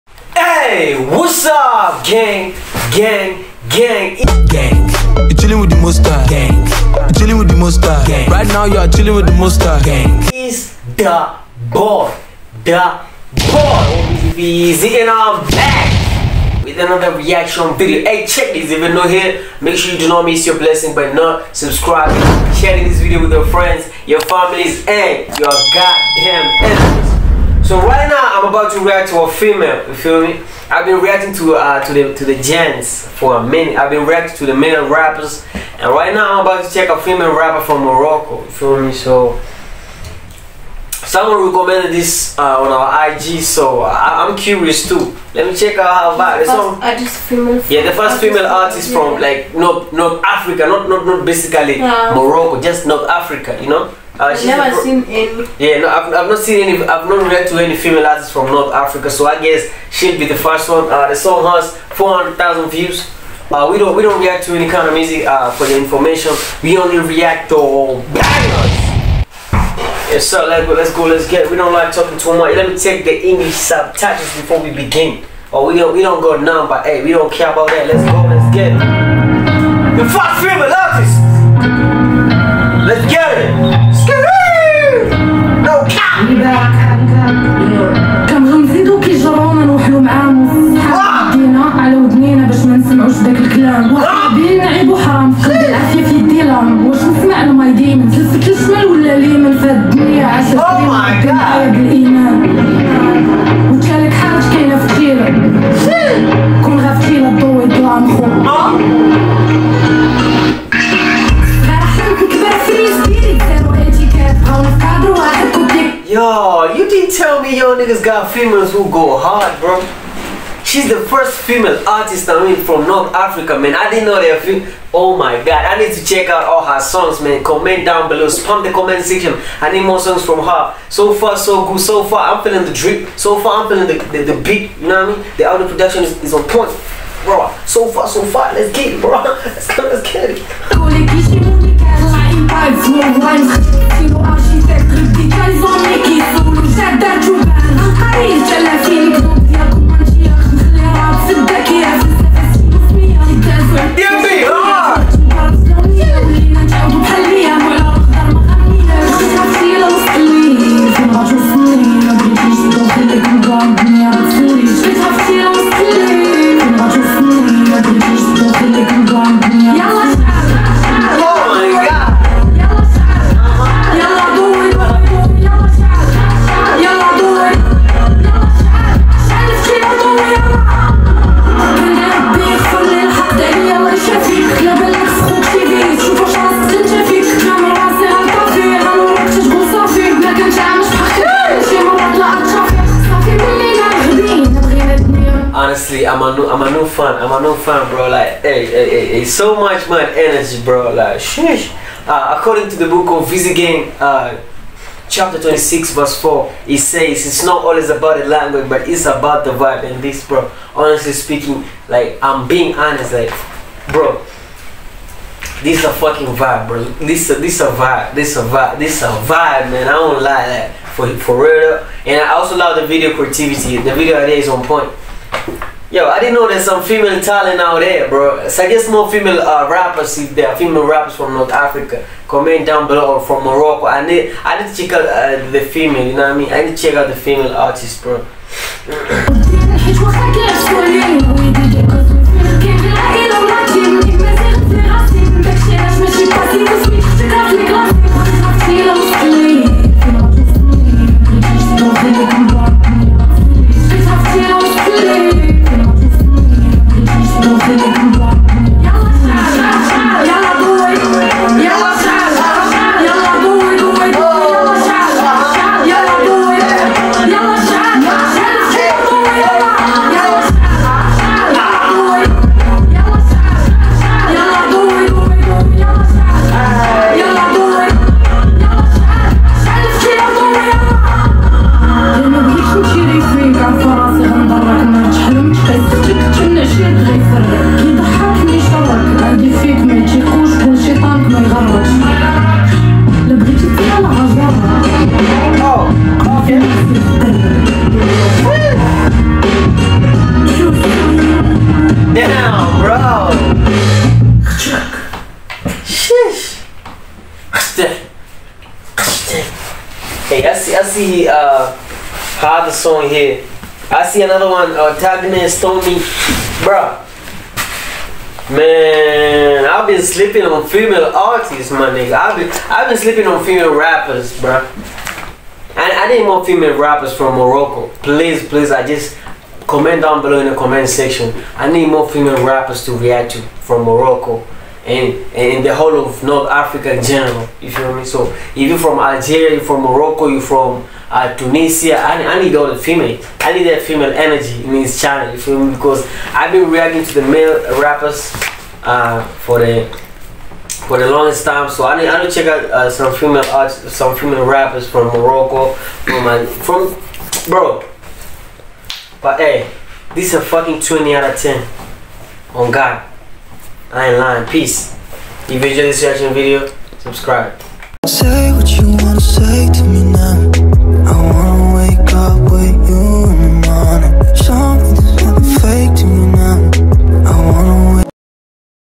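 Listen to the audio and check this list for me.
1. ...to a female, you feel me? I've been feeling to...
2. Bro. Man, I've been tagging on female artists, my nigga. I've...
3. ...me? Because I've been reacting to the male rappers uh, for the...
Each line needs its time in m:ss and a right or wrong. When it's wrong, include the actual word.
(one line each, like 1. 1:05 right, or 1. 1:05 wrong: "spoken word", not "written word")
1. 0:29 wrong: "reacting", not "feeling"
2. 5:16 wrong: "sleeping", not "tagging"
3. 5:45 right.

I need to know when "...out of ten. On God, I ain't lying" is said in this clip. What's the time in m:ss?
6:01.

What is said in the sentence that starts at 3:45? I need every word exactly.
Yo, I didn't know there's some female talent out there, bro.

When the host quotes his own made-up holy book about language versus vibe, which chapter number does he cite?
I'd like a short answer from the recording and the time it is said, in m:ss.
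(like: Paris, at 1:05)
26, at 3:25.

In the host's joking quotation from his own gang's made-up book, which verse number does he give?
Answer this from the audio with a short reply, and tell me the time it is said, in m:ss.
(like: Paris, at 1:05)
4, at 3:25.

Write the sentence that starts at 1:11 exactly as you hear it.
We don't like talking too much.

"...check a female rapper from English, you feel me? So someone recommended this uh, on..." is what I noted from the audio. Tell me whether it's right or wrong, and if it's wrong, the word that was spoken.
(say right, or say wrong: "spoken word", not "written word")
wrong: "Morocco", not "English".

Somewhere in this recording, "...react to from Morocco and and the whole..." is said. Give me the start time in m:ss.
5:32.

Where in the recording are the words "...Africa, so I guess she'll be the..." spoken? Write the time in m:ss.
0:58.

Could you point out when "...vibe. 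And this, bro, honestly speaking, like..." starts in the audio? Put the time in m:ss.
3:29.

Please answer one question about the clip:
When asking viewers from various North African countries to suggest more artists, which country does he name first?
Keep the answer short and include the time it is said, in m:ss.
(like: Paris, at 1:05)
Algeria, at 5:38.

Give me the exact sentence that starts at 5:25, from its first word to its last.
And I need more female rappers from Morocco.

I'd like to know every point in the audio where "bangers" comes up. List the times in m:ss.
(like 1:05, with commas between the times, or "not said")
1:08.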